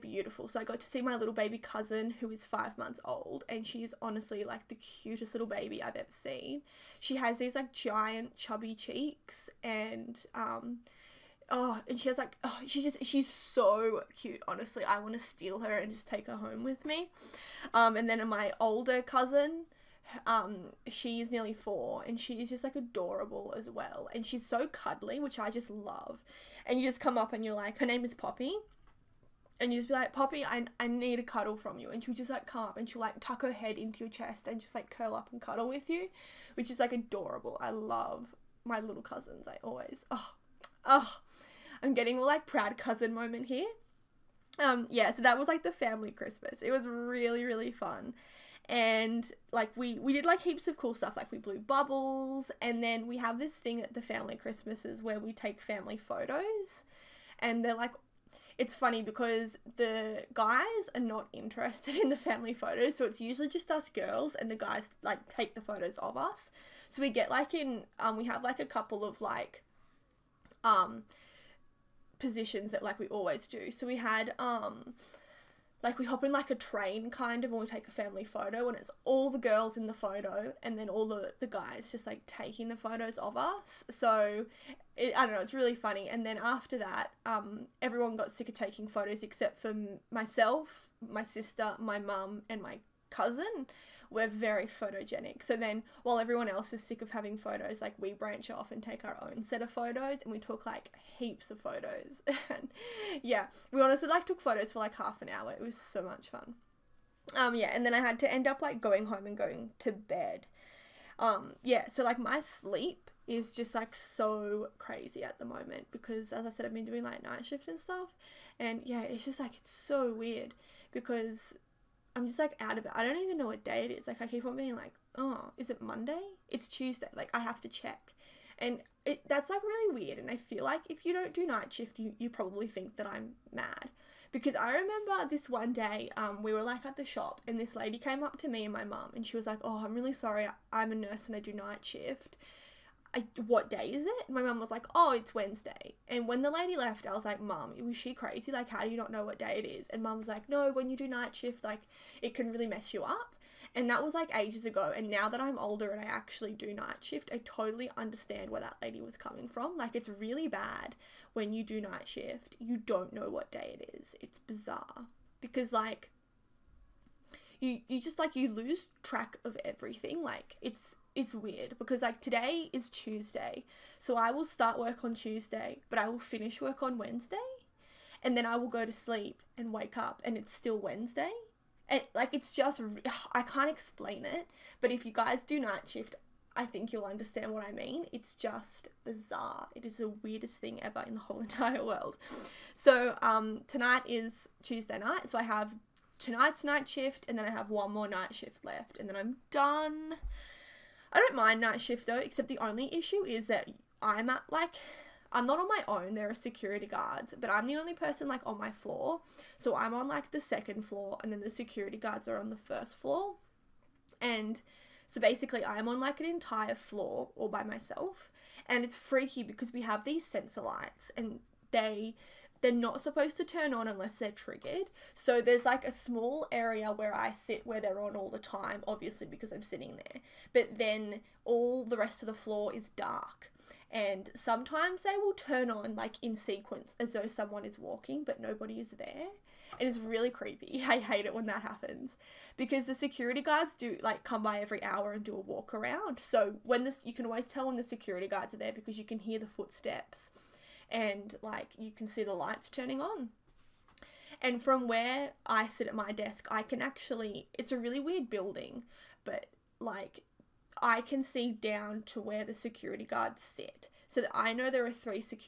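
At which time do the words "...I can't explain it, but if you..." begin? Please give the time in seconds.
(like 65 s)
183 s.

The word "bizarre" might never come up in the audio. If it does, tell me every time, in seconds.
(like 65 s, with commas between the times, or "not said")
164 s, 189 s.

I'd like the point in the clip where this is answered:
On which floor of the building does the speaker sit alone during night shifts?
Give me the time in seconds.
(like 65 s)
210 s.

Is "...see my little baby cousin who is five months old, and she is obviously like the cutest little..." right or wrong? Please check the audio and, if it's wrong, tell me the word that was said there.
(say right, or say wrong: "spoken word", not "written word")
wrong: "honestly", not "obviously".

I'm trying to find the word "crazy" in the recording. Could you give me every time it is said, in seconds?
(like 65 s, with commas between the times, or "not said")
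114 s, 148 s.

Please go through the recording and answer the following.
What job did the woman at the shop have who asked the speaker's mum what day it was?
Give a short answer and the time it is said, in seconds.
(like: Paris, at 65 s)
nurse, at 140 s.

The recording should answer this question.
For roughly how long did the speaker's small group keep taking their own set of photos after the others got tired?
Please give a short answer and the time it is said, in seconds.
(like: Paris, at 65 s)
half an hour, at 104 s.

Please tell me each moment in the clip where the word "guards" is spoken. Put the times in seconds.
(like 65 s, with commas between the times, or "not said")
206 s, 211 s, 243 s, 248 s, 263 s.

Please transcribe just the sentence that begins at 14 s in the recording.
Honestly, I want to steal her and just take her home with me.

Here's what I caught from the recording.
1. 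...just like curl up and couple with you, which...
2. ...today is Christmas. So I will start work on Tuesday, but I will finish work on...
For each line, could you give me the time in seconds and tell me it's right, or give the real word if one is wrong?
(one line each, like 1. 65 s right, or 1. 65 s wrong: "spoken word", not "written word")
1. 34 s wrong: "cuddle", not "couple"
2. 172 s wrong: "Tuesday", not "Christmas".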